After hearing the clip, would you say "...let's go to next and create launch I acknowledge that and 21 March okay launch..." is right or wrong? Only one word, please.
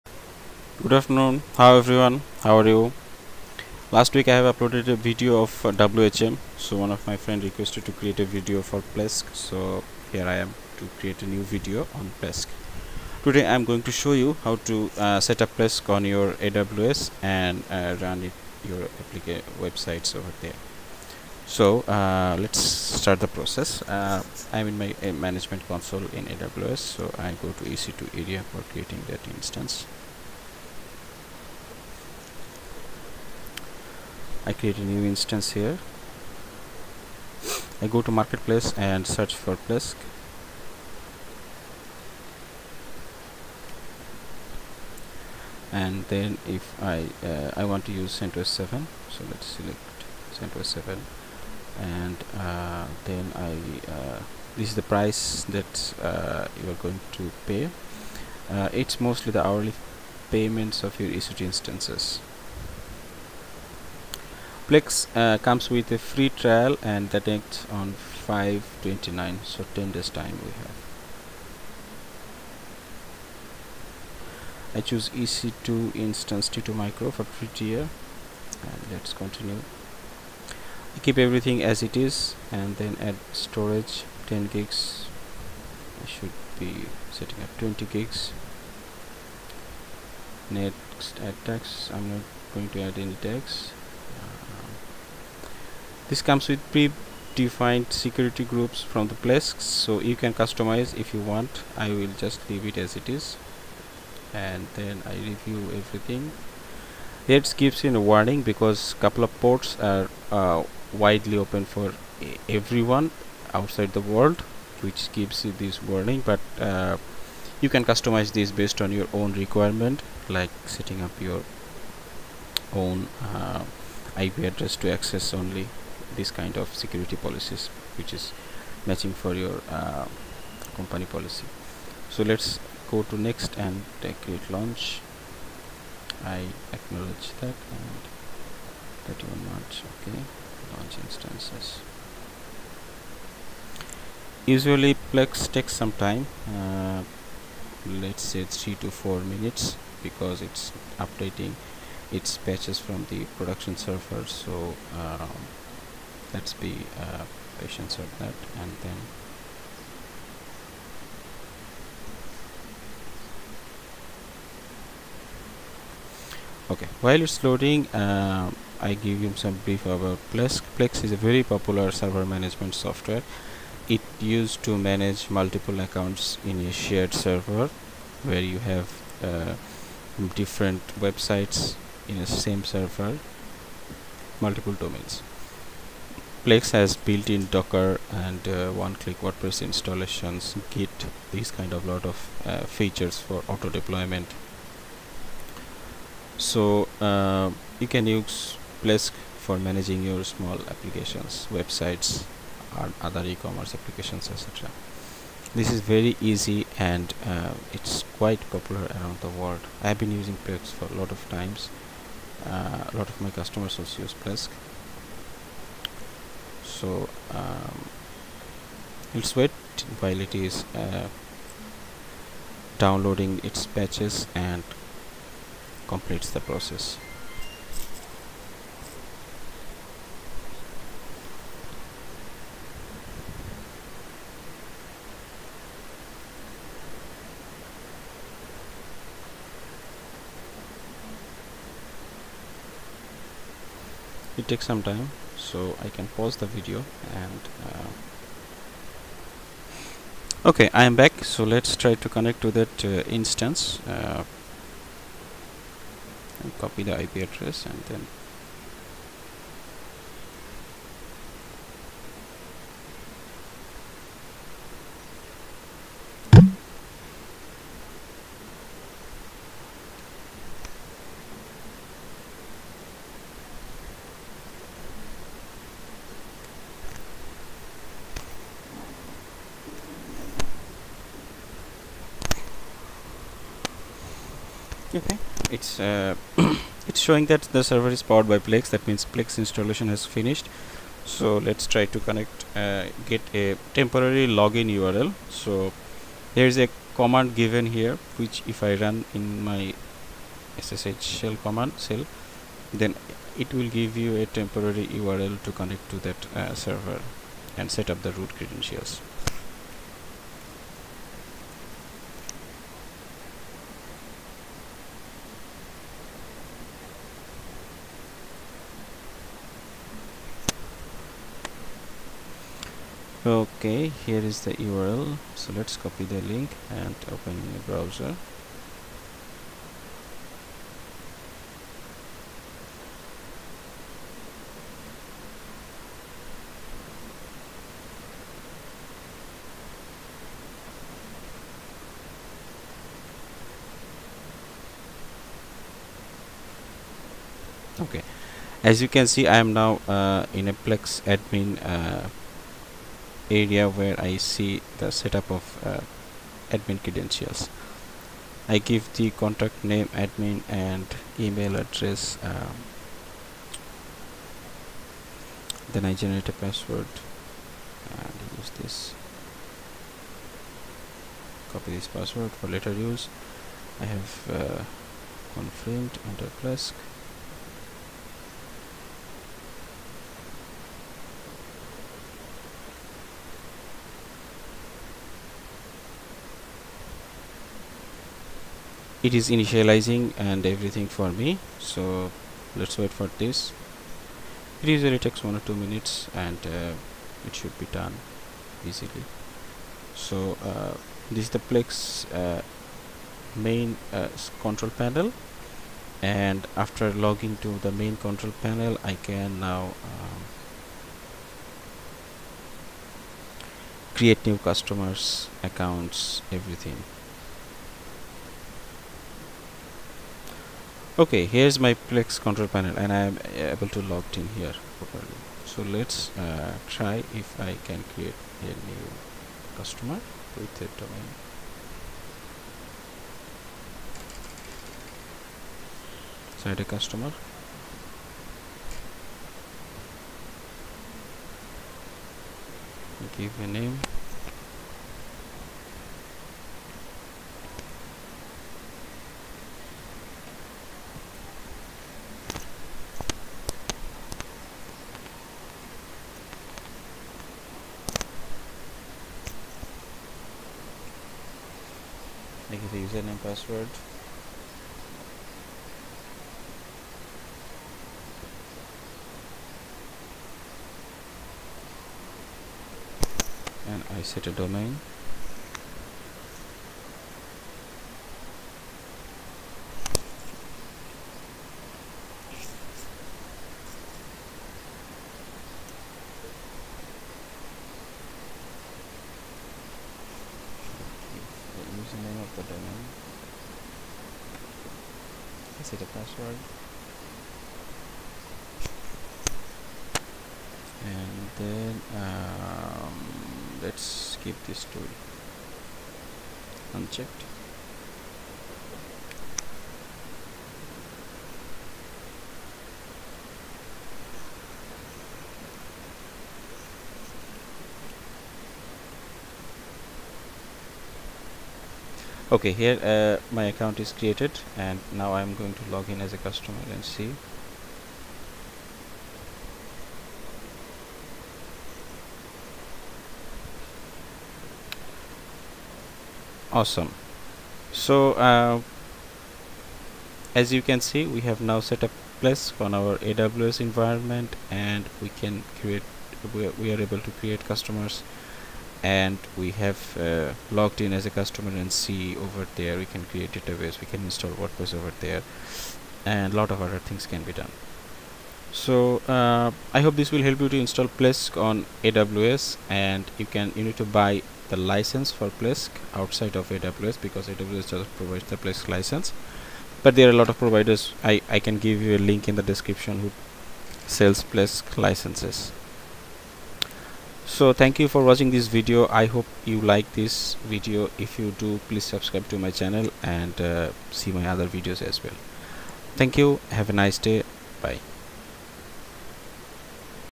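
wrong.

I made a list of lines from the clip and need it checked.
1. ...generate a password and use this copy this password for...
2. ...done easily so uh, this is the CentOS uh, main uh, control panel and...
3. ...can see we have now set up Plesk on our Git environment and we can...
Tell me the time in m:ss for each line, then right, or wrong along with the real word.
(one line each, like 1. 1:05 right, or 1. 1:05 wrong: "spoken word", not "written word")
1. 6:05 right
2. 6:37 wrong: "Plesk", not "CentOS"
3. 9:00 wrong: "AWS", not "Git".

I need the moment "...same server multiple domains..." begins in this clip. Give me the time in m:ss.
3:02.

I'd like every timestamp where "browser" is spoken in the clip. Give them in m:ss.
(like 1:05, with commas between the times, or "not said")
5:27.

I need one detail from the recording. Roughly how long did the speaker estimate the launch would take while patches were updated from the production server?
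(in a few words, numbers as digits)
3 to 4 minutes.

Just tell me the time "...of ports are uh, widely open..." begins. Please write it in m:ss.
1:49.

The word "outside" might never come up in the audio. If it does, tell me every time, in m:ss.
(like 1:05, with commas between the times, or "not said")
1:53, 9:25.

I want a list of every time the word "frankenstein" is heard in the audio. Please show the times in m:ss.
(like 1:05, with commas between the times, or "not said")
not said.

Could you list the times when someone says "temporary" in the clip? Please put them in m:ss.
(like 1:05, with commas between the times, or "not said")
4:53, 5:04.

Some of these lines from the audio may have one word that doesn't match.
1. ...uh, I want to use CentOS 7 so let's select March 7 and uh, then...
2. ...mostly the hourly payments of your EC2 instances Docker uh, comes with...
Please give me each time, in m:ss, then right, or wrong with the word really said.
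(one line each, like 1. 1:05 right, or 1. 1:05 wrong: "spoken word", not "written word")
1. 0:47 wrong: "CentOS", not "March"
2. 0:58 wrong: "Plesk", not "Docker".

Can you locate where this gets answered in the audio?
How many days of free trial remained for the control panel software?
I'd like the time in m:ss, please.
1:09.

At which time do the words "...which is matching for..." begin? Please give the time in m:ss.
2:07.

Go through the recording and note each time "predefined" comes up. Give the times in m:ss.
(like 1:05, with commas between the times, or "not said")
1:36.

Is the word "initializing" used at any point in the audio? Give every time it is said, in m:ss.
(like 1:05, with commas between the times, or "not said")
6:29.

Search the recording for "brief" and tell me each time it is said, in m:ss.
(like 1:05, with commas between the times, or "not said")
2:49.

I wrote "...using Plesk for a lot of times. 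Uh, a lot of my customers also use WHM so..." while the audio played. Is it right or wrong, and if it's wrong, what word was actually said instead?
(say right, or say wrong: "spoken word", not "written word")
wrong: "Plesk", not "WHM".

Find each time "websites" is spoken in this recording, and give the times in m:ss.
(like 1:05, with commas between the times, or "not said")
0:19, 3:00, 3:21.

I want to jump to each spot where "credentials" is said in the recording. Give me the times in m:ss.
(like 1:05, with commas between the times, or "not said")
5:08, 5:56.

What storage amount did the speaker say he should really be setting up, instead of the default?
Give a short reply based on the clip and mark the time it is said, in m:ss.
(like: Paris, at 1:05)
20 gigs, at 1:27.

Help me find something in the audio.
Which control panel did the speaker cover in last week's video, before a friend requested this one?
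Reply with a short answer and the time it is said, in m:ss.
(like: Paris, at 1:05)
WHM, at 0:05.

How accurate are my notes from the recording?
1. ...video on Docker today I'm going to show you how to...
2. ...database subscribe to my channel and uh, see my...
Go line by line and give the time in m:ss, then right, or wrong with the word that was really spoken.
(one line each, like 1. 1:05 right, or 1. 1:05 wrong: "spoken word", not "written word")
1. 0:11 wrong: "Plesk", not "Docker"
2. 9:41 wrong: "please", not "database".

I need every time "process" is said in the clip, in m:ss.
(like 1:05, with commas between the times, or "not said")
0:23, 3:46.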